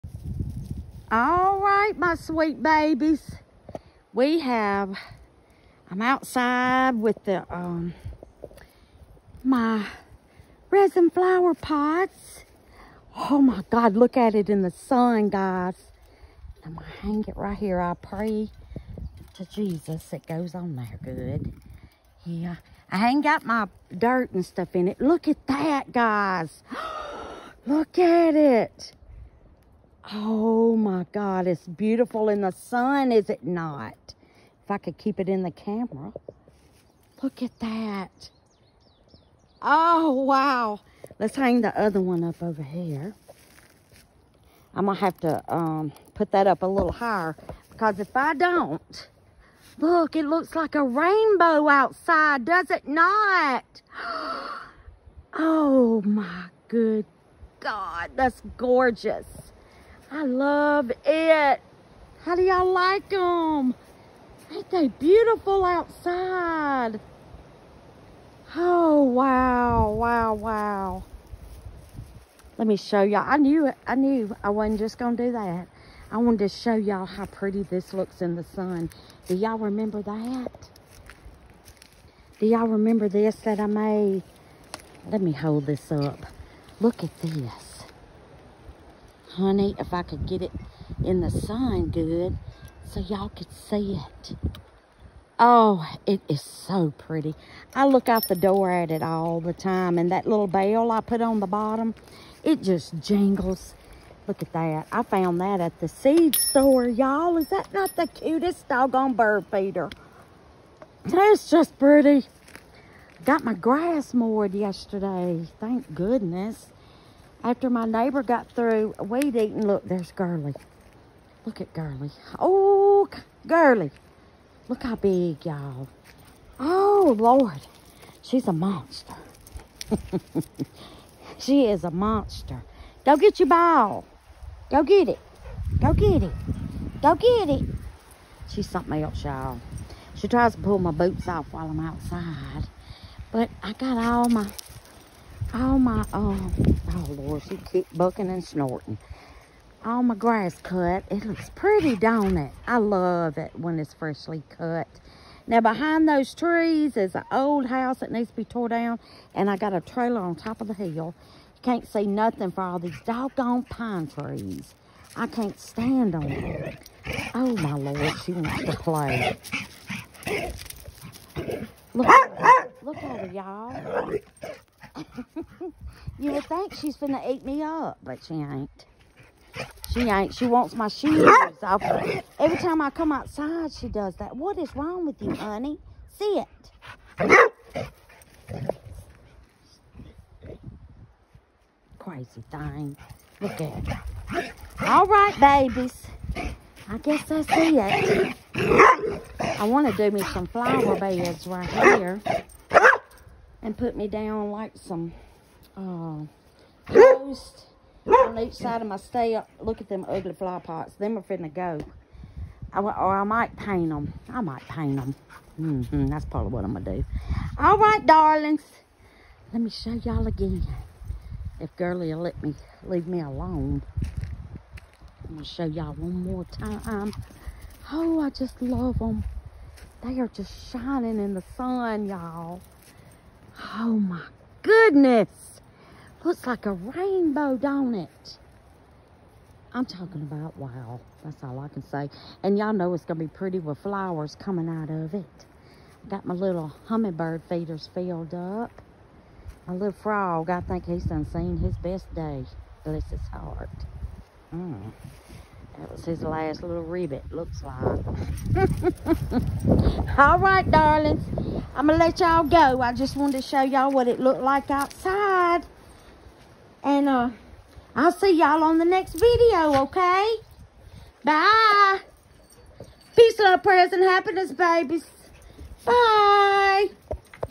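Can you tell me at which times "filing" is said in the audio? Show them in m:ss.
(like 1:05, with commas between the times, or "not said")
not said.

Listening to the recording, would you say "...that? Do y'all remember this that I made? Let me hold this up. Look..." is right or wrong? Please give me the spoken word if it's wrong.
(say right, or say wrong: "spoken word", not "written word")
right.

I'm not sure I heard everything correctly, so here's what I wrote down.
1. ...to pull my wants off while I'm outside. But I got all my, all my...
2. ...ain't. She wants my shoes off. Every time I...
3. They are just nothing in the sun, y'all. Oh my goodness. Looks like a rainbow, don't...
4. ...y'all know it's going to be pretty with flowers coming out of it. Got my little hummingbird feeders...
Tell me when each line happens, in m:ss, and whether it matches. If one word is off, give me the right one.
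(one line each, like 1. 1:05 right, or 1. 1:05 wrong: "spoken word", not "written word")
1. 2:20 wrong: "boots", not "wants"
2. 3:00 right
3. 3:50 wrong: "shining", not "nothing"
4. 4:02 right.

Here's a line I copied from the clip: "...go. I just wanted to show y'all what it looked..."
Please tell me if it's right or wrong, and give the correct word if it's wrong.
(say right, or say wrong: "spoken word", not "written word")
right.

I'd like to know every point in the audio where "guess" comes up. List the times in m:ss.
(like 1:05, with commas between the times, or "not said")
3:16.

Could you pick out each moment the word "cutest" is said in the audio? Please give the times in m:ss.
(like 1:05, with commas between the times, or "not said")
1:48.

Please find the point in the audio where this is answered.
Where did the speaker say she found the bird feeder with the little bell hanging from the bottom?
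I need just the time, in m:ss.
1:45.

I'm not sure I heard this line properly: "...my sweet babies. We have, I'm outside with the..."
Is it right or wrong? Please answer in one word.
right.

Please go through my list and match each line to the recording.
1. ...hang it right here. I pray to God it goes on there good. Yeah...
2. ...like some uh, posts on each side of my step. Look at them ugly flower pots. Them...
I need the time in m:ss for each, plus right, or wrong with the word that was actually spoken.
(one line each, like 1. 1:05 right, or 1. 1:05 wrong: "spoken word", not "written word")
1. 0:17 wrong: "Jesus", not "God"
2. 3:24 right.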